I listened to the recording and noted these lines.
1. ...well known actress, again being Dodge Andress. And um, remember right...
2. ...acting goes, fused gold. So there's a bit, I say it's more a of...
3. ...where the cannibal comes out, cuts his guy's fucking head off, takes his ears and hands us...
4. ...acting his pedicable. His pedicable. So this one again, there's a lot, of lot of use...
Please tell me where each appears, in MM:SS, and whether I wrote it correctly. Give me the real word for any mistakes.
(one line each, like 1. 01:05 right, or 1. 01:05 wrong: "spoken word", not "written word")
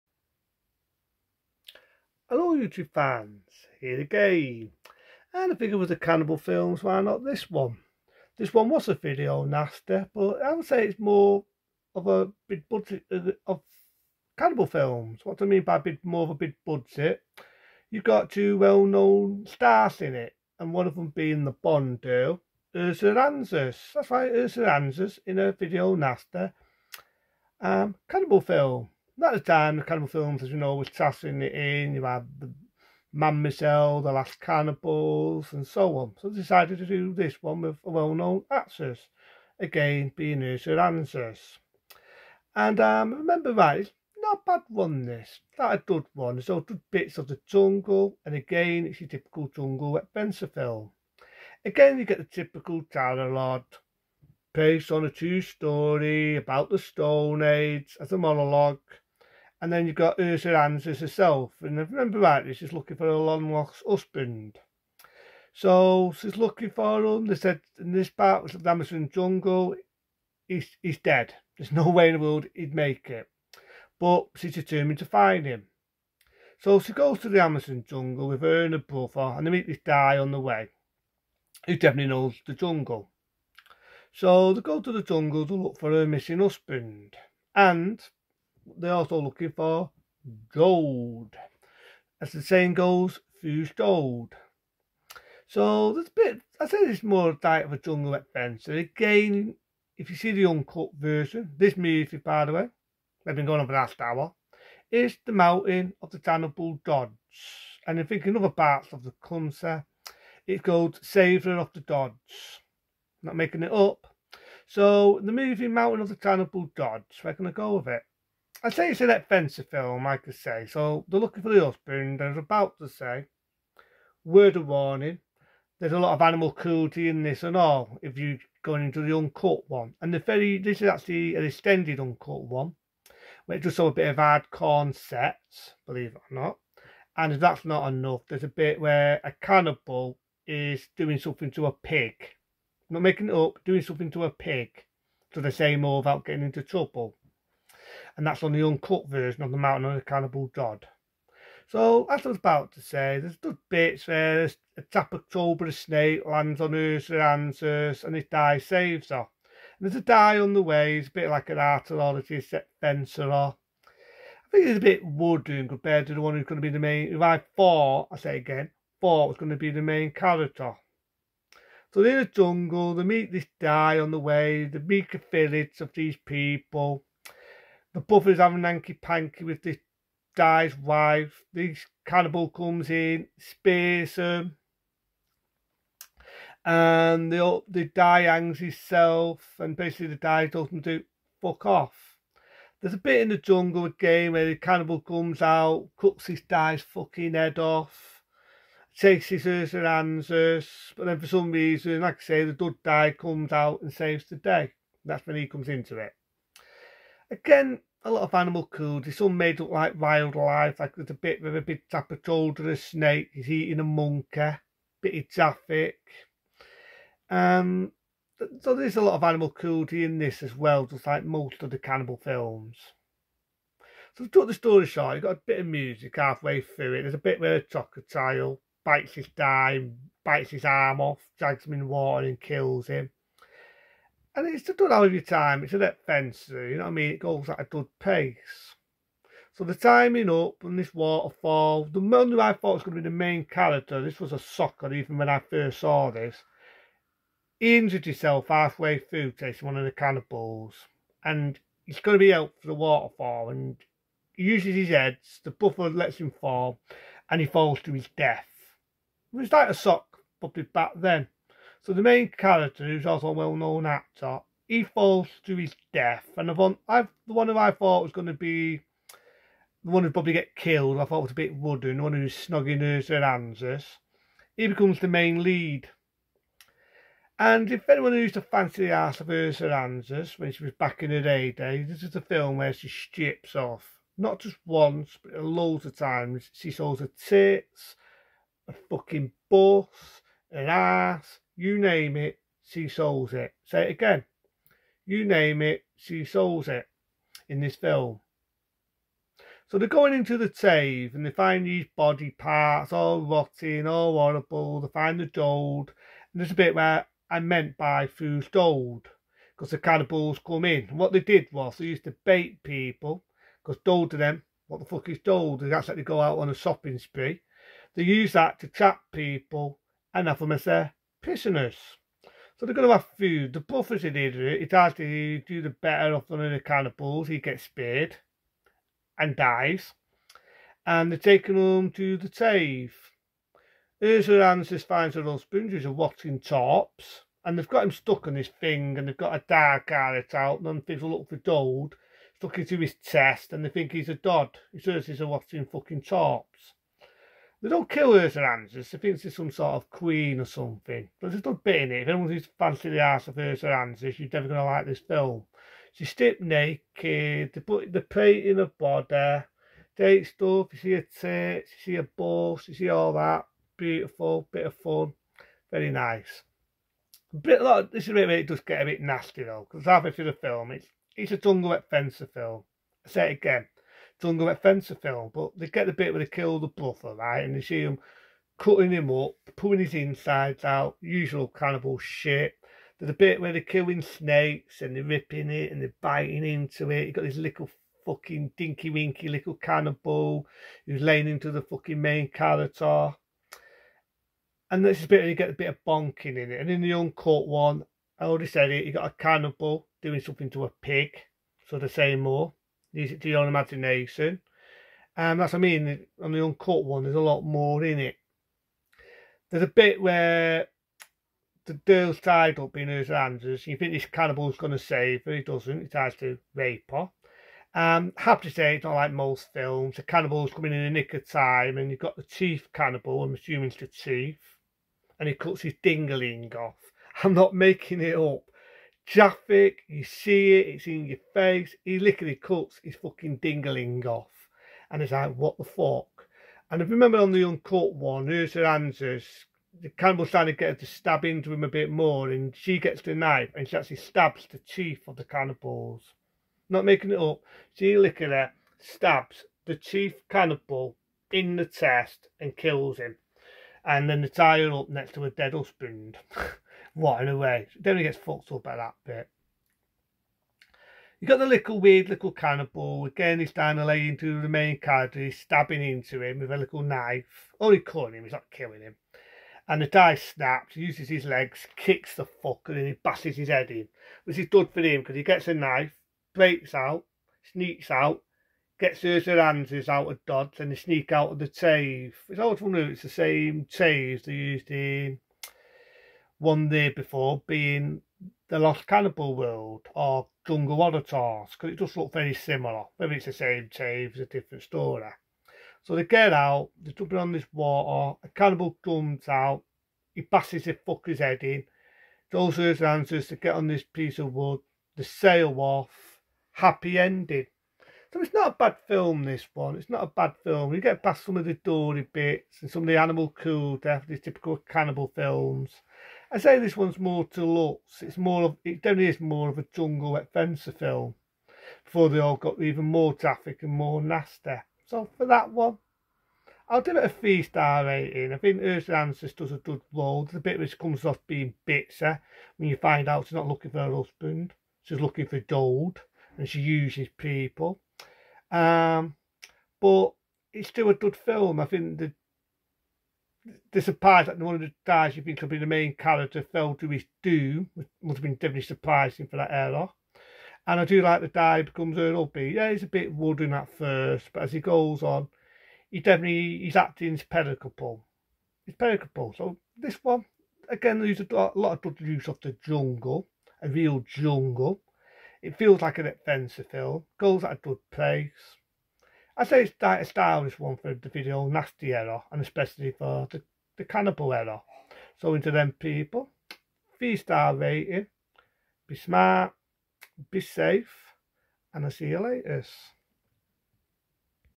1. 00:37 wrong: "Ursula", not "Dodge"
2. 01:32 wrong: "saying", not "acting"
3. 03:14 right
4. 09:16 right.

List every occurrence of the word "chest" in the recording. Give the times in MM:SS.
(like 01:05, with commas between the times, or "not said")
05:42, 07:31.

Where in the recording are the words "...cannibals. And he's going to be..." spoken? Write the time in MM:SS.
04:09.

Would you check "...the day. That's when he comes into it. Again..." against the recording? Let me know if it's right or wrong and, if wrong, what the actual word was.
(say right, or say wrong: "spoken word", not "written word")
right.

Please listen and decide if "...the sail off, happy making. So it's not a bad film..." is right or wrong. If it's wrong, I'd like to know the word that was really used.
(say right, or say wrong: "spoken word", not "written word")
wrong: "ending", not "making".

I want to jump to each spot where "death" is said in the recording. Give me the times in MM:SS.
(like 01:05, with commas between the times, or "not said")
04:18, 04:25, 08:33.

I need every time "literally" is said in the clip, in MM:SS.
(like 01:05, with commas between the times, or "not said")
07:11, 07:27.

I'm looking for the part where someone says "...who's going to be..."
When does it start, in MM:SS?
02:46.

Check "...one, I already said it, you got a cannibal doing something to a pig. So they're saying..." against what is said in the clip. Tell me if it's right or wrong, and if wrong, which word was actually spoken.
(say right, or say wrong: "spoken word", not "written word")
right.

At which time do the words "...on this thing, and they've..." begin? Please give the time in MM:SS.
05:38.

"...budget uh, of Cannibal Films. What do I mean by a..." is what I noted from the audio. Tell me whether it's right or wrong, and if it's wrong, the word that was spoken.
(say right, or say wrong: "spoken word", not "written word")
right.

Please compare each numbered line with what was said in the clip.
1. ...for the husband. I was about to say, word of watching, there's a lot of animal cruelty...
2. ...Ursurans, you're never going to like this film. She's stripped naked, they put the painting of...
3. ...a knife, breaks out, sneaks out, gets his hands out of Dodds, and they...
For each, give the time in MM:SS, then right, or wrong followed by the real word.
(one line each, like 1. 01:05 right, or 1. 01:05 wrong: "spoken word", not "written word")
1. 02:01 wrong: "warning", not "watching"
2. 05:53 right
3. 07:55 right.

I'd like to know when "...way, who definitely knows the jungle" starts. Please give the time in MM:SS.
01:20.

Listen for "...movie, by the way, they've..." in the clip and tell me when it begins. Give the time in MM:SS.
01:41.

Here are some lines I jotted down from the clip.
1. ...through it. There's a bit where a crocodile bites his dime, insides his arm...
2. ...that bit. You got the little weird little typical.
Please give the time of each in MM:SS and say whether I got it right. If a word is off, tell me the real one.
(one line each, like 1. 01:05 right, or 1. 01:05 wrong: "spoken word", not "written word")
1. 03:46 wrong: "bites", not "insides"
2. 07:38 wrong: "cannibal", not "typical".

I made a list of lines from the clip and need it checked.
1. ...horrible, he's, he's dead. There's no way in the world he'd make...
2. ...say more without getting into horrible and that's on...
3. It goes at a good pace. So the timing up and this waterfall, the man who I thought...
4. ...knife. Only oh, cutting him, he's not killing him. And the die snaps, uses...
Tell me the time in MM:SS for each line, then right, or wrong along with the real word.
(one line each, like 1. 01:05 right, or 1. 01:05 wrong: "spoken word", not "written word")
1. 01:09 wrong: "jungle", not "horrible"
2. 02:25 wrong: "trouble", not "horrible"
3. 03:57 right
4. 07:46 right.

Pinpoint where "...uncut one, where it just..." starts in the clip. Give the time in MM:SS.
02:11.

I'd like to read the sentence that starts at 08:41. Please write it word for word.
Before they all got even more traffic and more nasty.